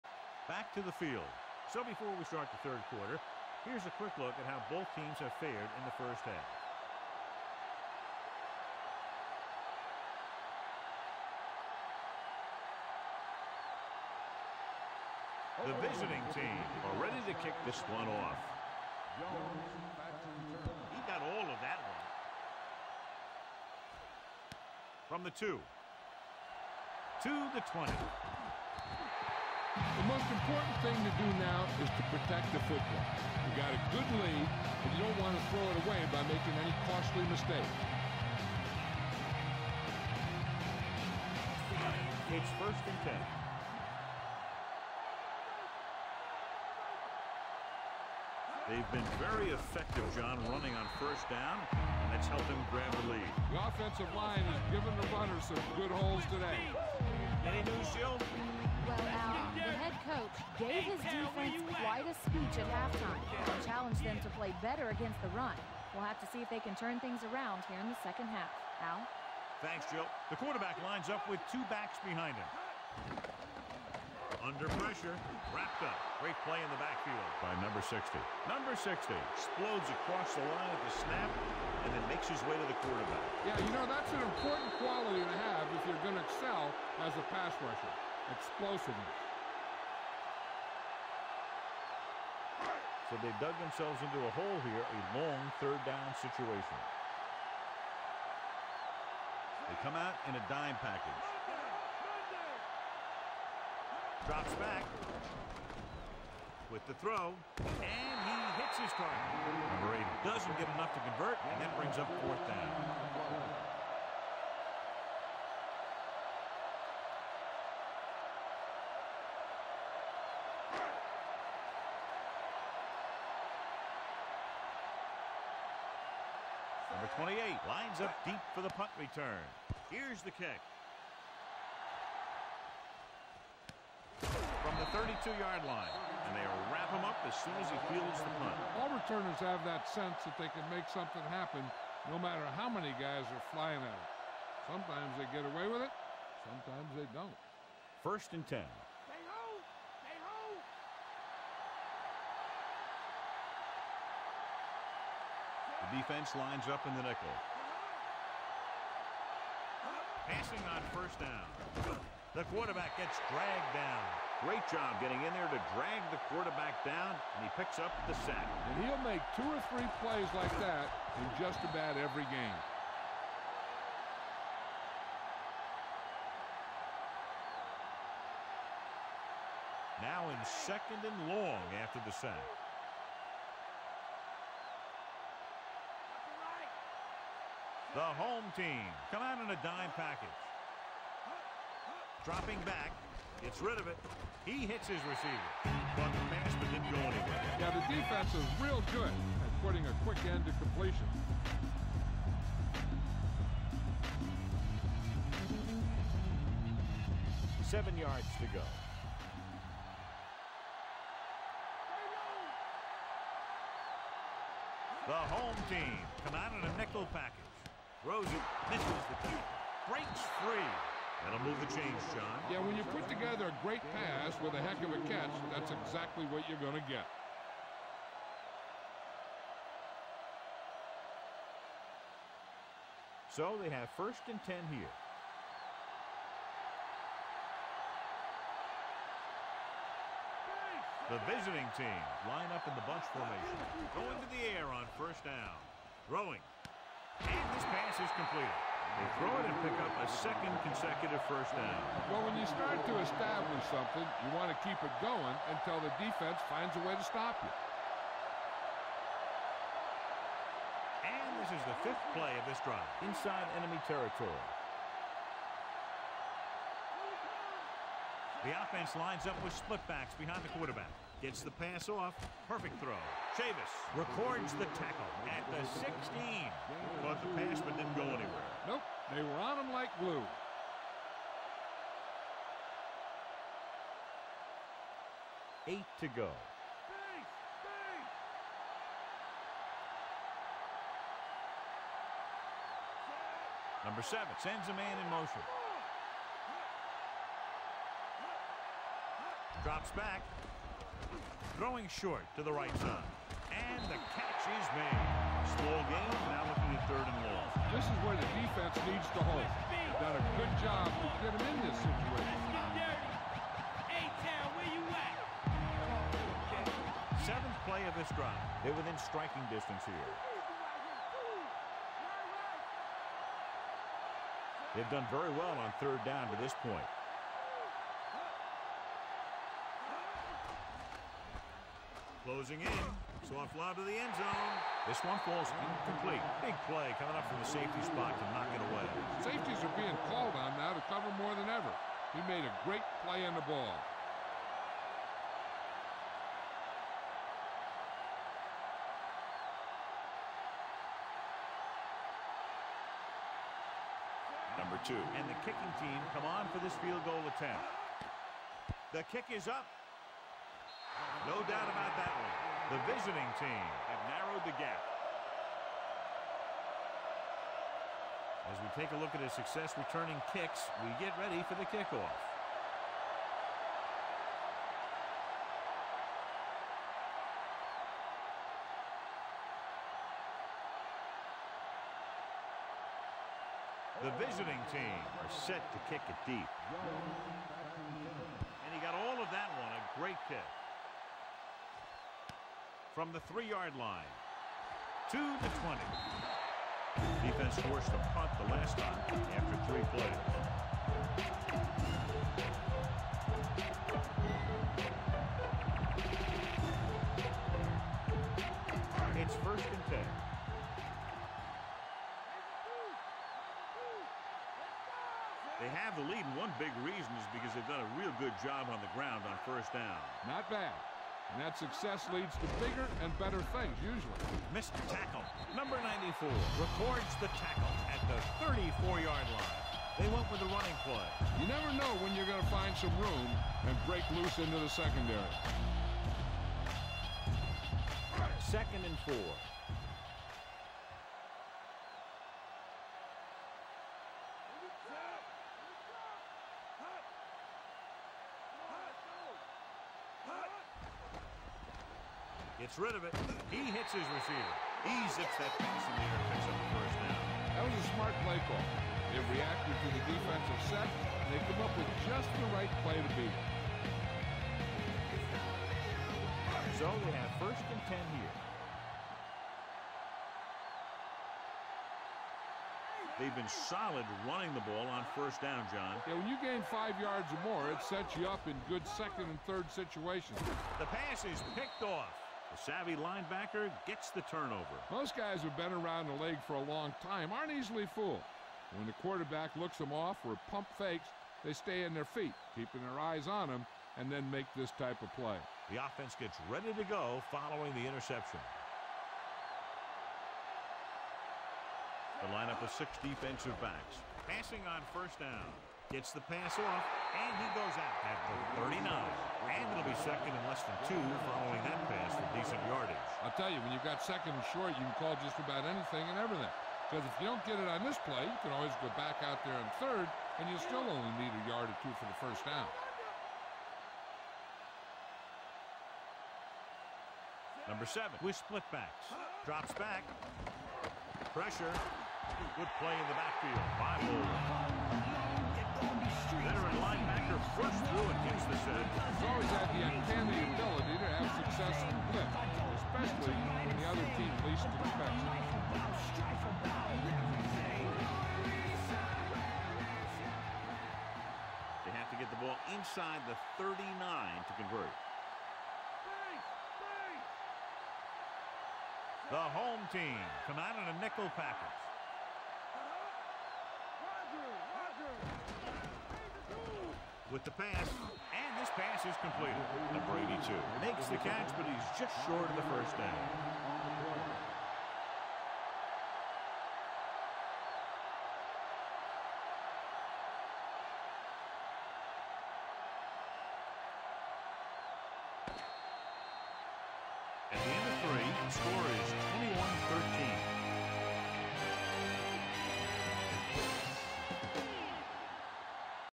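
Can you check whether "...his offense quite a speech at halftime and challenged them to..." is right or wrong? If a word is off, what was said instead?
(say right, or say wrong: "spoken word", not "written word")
wrong: "defense", not "offense".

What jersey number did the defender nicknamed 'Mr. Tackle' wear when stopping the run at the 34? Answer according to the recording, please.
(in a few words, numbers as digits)
94.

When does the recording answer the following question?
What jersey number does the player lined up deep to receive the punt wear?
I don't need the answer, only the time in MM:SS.
02:06.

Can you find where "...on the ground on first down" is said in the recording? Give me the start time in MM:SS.
06:58.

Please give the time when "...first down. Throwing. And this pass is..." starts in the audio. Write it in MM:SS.
04:04.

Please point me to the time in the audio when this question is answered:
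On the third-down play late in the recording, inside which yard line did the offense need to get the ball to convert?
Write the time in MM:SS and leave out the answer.
09:12.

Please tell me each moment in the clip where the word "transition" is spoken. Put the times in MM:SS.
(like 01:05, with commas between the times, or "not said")
not said.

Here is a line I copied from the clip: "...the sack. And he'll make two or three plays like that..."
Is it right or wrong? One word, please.
right.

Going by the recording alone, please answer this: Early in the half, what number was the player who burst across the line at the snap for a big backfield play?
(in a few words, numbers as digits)
60.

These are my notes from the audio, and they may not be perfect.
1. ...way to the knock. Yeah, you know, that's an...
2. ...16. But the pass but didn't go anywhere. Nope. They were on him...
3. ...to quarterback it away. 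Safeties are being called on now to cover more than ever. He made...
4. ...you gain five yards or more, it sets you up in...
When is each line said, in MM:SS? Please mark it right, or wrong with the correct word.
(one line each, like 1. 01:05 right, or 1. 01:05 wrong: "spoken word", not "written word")
1. 01:22 wrong: "quarterback", not "knock"
2. 04:35 right
3. 05:38 wrong: "knock", not "quarterback"
4. 07:56 right.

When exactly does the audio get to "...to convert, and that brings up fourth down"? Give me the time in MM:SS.
01:50.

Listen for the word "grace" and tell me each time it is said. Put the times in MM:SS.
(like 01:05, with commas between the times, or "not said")
not said.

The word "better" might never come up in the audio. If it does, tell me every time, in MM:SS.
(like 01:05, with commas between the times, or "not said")
01:04, 07:03.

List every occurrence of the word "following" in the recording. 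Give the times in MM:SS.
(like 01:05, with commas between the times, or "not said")
08:17, 08:31.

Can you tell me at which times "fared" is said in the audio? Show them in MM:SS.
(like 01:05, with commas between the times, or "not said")
00:05.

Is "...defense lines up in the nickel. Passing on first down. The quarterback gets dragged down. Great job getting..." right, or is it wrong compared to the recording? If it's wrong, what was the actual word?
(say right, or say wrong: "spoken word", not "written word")
right.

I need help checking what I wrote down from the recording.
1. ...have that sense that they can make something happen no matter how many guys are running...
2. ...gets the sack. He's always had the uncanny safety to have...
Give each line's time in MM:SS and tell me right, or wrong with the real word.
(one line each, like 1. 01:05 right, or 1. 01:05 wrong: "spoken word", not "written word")
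1. 02:19 wrong: "flying", not "running"
2. 08:58 wrong: "ability", not "safety".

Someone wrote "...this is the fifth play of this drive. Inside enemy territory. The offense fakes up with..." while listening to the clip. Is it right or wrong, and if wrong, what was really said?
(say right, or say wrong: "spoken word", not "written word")
wrong: "lines", not "fakes".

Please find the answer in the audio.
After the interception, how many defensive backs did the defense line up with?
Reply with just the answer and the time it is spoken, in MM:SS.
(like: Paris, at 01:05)
6, at 08:22.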